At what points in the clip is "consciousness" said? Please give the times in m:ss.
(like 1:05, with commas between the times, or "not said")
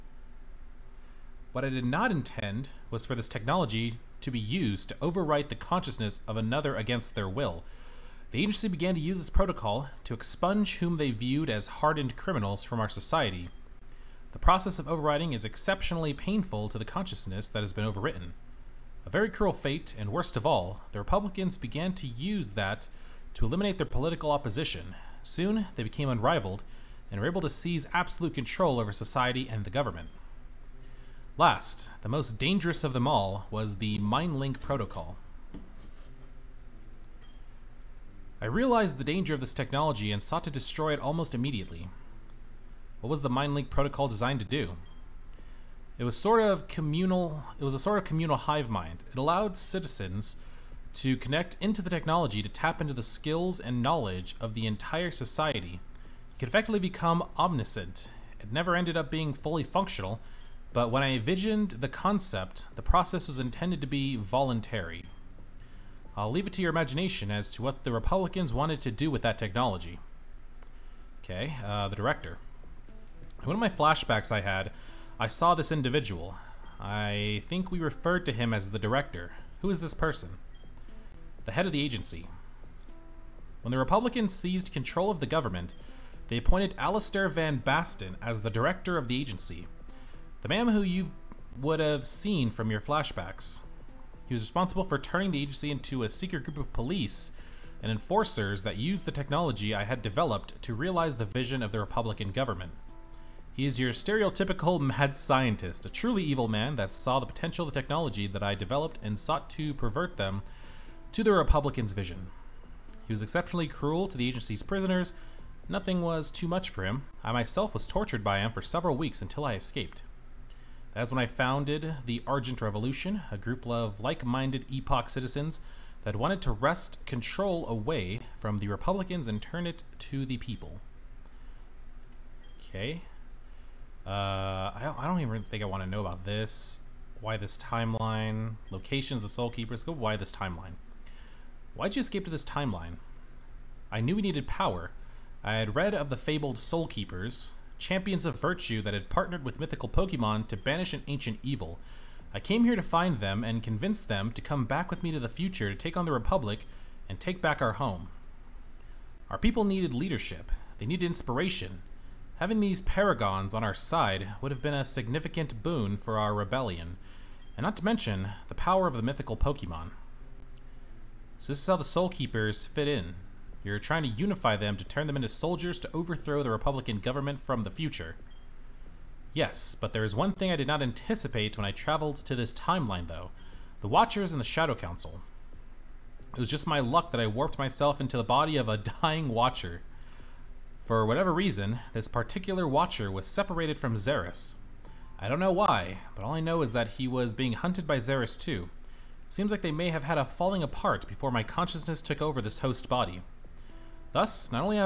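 0:05, 0:16, 3:21.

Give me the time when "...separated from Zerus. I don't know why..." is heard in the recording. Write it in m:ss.
3:13.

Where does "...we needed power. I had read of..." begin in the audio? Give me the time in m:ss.
2:24.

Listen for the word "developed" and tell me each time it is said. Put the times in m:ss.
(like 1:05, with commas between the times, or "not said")
1:40, 1:48.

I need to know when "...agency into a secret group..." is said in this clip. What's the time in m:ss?
1:35.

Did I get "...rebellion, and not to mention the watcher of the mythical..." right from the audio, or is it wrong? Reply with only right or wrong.
wrong.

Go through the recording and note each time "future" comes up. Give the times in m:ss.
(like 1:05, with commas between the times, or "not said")
2:35, 2:57.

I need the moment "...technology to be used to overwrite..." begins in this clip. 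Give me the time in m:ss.
0:03.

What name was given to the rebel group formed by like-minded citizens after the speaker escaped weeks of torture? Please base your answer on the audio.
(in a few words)
Argent Revolution.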